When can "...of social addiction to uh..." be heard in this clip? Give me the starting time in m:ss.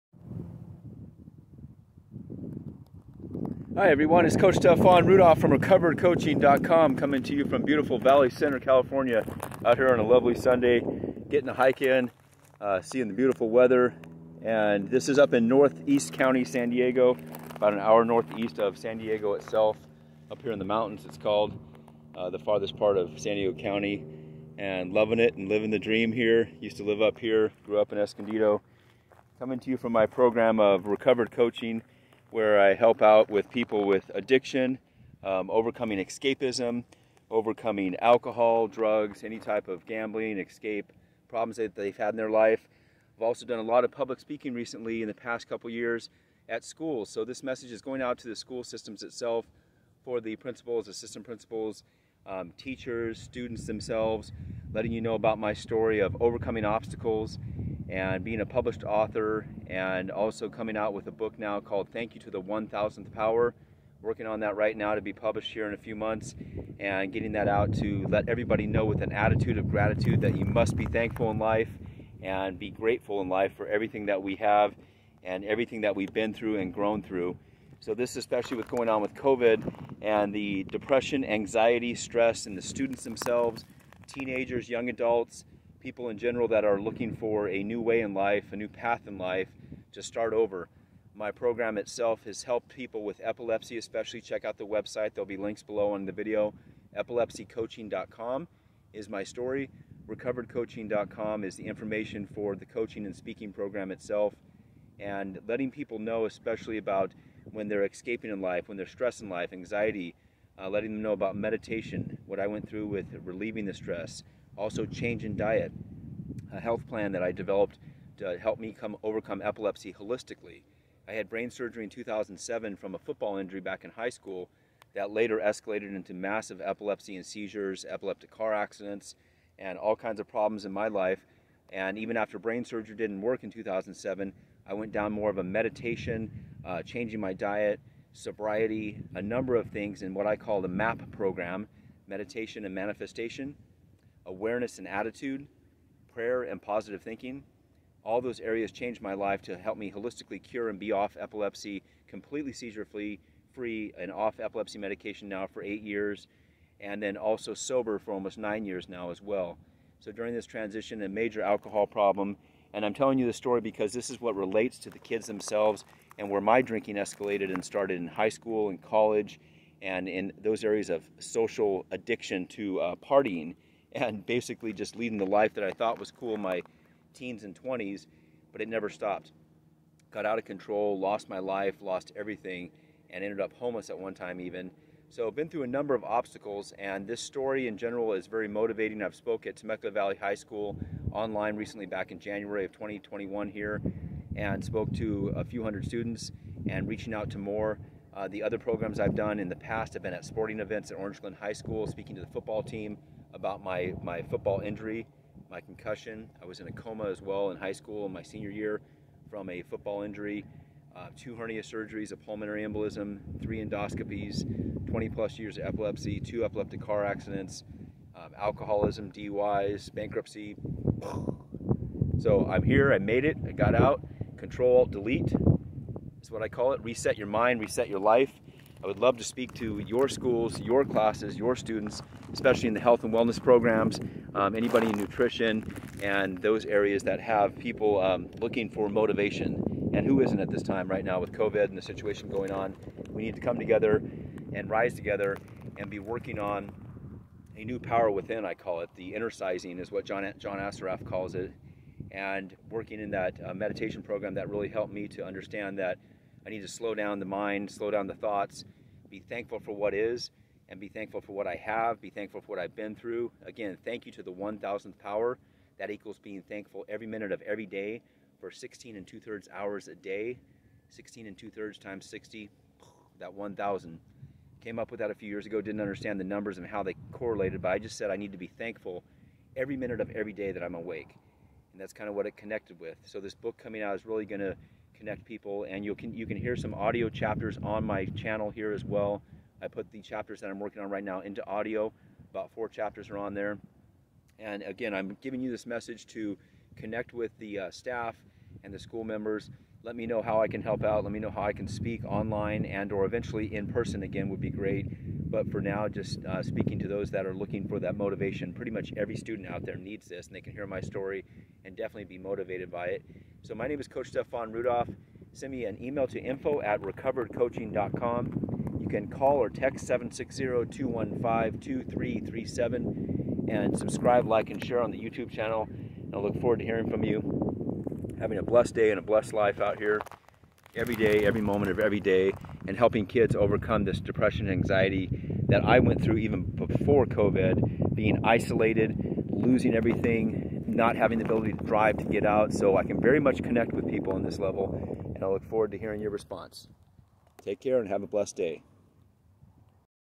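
2:50.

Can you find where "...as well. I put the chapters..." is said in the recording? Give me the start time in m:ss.
4:48.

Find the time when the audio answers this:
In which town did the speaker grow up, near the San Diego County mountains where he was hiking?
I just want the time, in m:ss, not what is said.
0:27.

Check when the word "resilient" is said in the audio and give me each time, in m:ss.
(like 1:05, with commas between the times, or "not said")
not said.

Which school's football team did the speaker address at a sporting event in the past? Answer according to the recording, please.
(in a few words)
Orange Glen High School.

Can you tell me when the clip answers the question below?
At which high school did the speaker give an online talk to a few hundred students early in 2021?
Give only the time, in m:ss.
3:09.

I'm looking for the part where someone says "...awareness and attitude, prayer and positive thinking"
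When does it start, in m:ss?
2:24.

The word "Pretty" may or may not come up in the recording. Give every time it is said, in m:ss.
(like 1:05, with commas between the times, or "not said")
5:08.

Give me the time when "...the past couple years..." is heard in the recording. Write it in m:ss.
0:45.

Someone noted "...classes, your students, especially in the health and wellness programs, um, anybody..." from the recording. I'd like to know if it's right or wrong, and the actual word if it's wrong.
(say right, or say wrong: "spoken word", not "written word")
right.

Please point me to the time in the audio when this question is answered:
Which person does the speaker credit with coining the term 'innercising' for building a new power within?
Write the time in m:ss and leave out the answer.
4:10.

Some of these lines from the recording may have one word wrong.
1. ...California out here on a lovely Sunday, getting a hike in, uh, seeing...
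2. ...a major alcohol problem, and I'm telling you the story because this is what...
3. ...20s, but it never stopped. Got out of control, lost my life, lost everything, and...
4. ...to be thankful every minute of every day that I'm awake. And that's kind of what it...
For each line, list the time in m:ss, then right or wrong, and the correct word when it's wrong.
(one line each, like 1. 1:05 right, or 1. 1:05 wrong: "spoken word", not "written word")
1. 0:08 right
2. 2:41 right
3. 2:57 right
4. 4:38 right.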